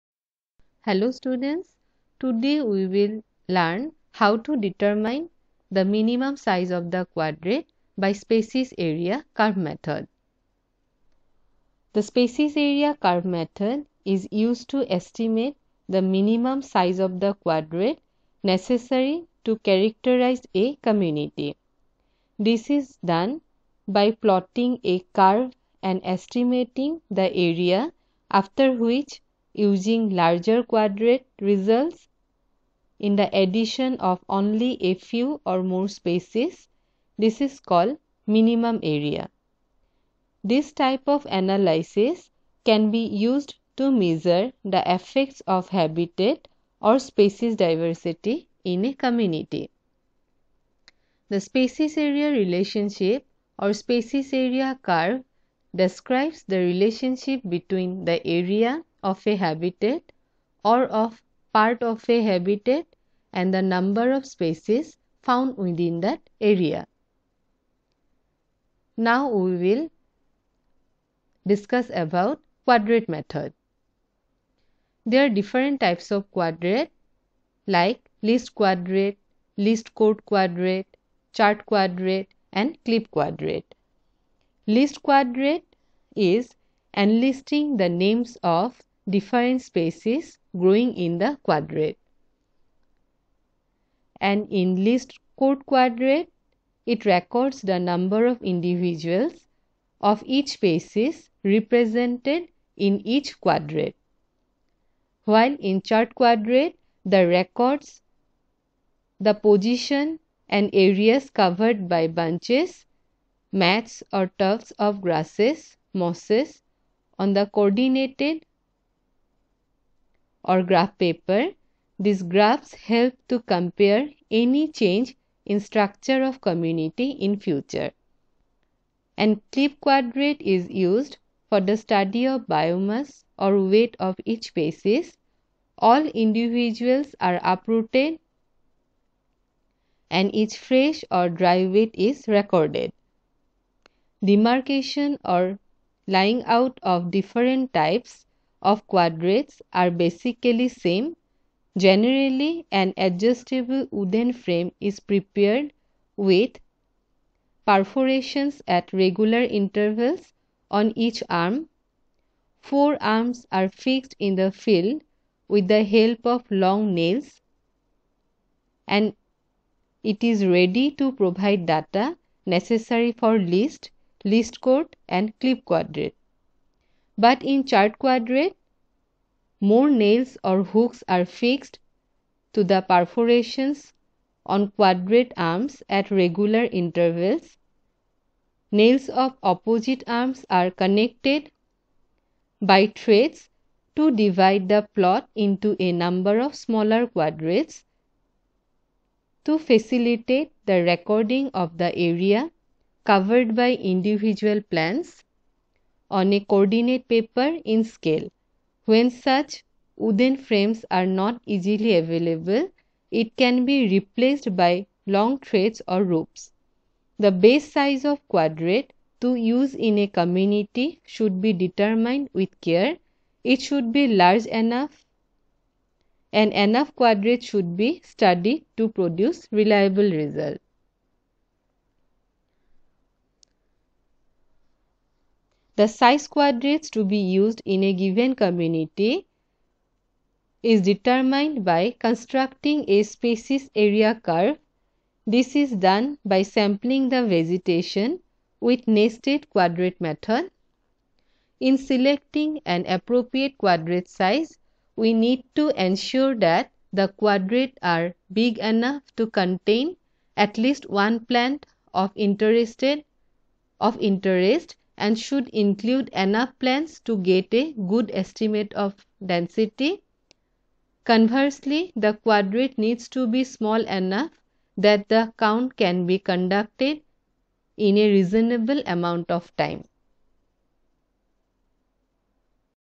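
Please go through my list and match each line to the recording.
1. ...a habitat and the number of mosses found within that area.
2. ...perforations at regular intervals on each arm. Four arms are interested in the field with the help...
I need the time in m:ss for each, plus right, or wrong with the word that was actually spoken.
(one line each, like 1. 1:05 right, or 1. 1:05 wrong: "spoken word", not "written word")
1. 1:02 wrong: "species", not "mosses"
2. 2:37 wrong: "fixed", not "interested".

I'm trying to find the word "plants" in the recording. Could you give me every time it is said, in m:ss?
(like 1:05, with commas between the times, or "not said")
3:24, 4:21, 4:26.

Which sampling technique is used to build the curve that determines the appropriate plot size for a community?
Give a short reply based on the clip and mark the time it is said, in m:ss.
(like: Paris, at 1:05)
Nested quadrate method, at 4:08.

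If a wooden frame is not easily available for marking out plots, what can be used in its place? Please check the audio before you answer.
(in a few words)
Long threads or ropes.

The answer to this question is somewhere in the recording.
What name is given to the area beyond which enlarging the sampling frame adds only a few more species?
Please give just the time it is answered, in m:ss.
0:38.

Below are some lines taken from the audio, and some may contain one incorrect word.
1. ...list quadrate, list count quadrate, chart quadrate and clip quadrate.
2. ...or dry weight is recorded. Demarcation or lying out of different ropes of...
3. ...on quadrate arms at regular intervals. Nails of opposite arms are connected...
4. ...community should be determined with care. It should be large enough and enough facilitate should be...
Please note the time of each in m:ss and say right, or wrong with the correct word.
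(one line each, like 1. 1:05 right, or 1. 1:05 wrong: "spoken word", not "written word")
1. 1:18 right
2. 2:21 wrong: "types", not "ropes"
3. 3:04 right
4. 3:40 wrong: "quadrate", not "facilitate".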